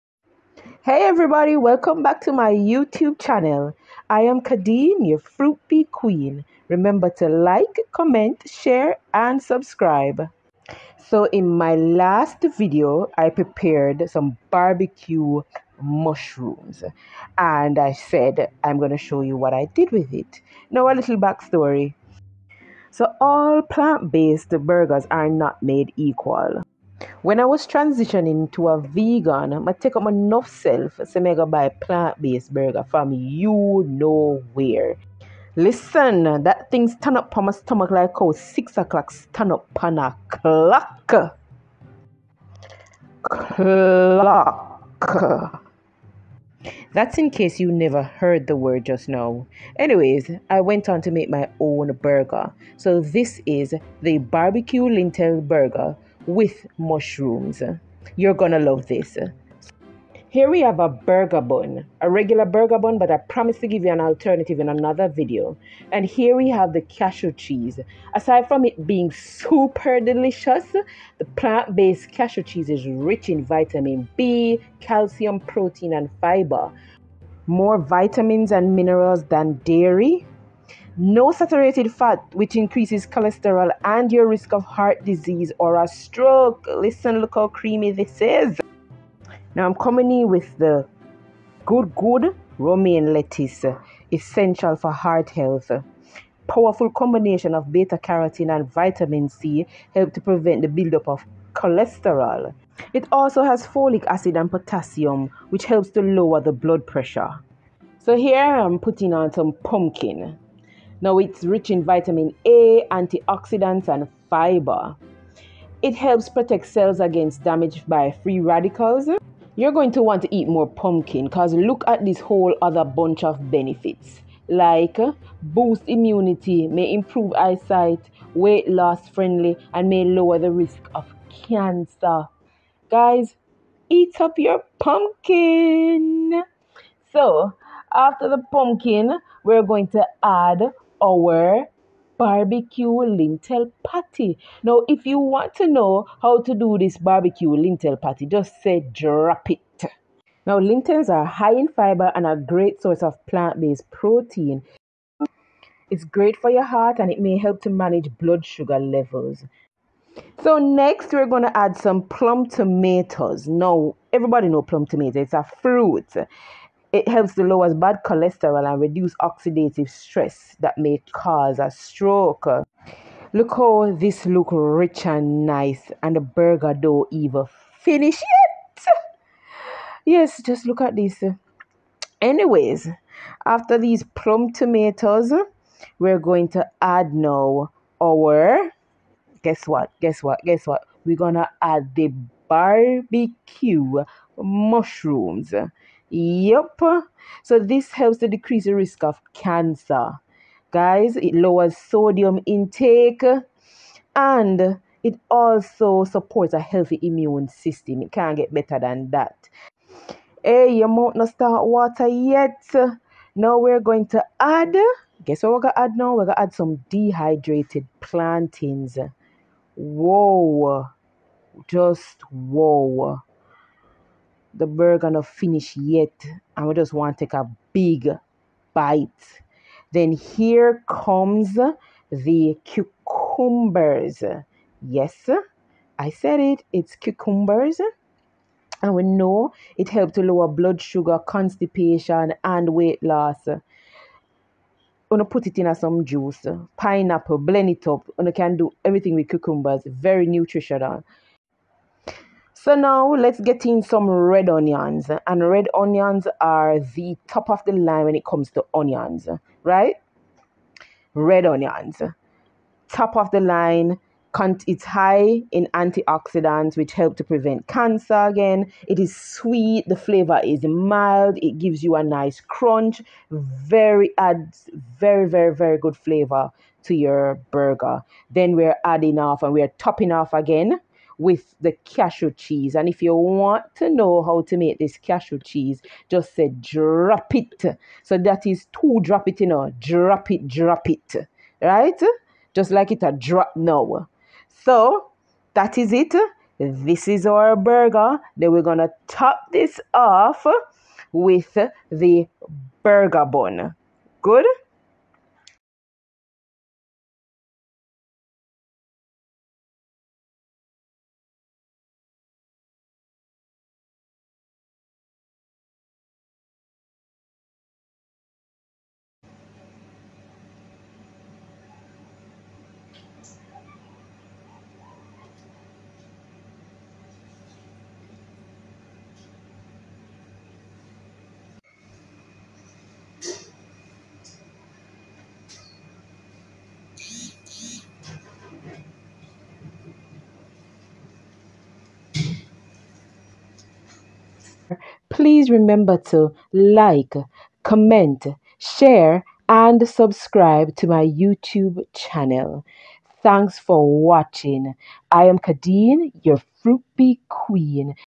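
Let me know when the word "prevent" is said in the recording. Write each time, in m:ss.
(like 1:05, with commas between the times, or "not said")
1:40, 4:27.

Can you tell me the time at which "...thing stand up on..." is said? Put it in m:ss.
0:36.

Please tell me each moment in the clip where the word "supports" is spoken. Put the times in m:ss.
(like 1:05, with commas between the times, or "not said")
3:26.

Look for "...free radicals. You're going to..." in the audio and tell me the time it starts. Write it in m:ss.
1:58.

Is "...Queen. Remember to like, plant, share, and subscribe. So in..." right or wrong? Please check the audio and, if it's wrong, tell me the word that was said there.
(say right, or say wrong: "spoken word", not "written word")
wrong: "comment", not "plant".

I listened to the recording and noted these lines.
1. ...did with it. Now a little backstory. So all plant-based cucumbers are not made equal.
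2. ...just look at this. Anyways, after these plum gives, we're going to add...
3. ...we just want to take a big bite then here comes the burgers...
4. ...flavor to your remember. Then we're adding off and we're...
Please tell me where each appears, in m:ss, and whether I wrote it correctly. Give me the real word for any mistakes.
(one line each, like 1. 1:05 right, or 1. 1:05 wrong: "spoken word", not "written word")
1. 0:19 wrong: "burgers", not "cucumbers"
2. 3:00 wrong: "tomatoes", not "gives"
3. 3:46 wrong: "cucumbers", not "burgers"
4. 4:35 wrong: "burger", not "remember".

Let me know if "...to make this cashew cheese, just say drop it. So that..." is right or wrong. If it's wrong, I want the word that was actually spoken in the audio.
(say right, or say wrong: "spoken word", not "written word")
right.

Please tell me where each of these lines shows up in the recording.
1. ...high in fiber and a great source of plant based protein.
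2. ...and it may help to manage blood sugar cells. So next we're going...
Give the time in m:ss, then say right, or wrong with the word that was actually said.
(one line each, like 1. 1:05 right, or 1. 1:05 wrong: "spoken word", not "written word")
1. 2:31 right
2. 2:36 wrong: "levels", not "cells".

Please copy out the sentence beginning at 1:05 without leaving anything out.
And here we have the cashew cheese.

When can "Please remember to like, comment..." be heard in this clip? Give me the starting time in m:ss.
5:45.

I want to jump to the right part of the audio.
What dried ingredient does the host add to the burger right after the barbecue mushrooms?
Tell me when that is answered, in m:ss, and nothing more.
3:36.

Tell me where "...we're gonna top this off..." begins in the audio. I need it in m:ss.
4:58.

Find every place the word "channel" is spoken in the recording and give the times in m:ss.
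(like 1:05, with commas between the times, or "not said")
0:03, 5:51.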